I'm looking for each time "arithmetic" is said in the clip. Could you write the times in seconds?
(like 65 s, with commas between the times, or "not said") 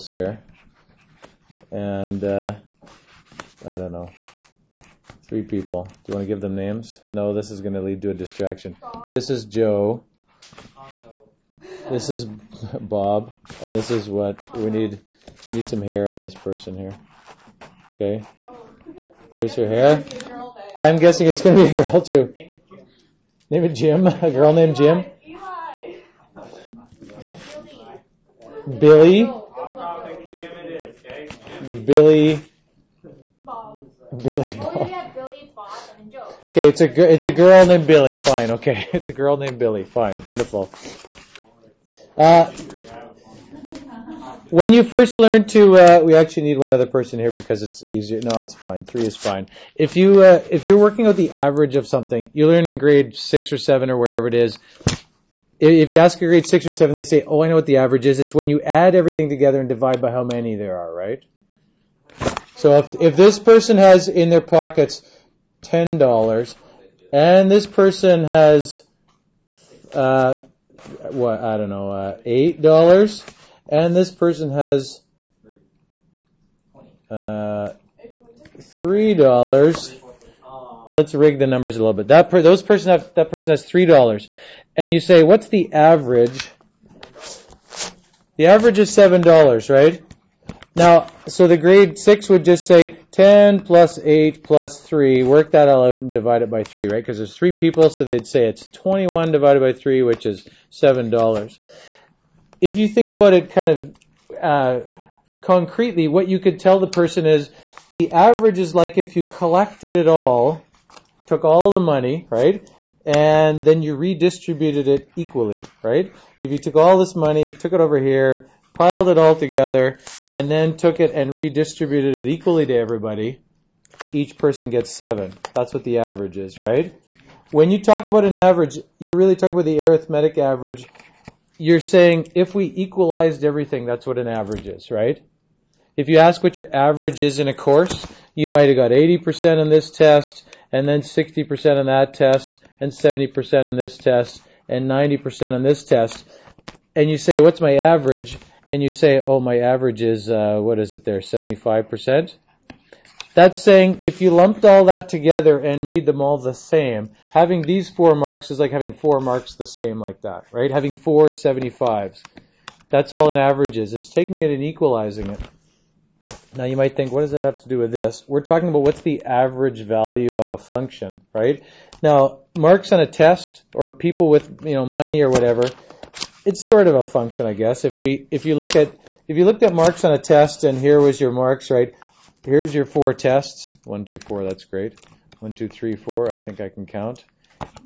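129 s.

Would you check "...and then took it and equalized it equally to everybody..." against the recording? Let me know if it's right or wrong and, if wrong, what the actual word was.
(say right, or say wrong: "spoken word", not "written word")
wrong: "redistributed", not "equalized".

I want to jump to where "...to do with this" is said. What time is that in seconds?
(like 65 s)
167 s.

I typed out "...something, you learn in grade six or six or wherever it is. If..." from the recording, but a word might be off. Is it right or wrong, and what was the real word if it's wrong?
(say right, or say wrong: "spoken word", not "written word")
wrong: "seven", not "six".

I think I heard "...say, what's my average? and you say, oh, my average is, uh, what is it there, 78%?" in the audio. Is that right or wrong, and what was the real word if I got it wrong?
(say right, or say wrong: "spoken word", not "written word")
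wrong: "75", not "78".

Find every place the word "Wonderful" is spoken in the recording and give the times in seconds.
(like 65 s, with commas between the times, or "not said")
40 s.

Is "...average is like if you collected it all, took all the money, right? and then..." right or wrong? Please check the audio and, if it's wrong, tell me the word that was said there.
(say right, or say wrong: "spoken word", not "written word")
right.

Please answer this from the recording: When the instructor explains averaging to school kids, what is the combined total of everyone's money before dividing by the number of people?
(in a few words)
21.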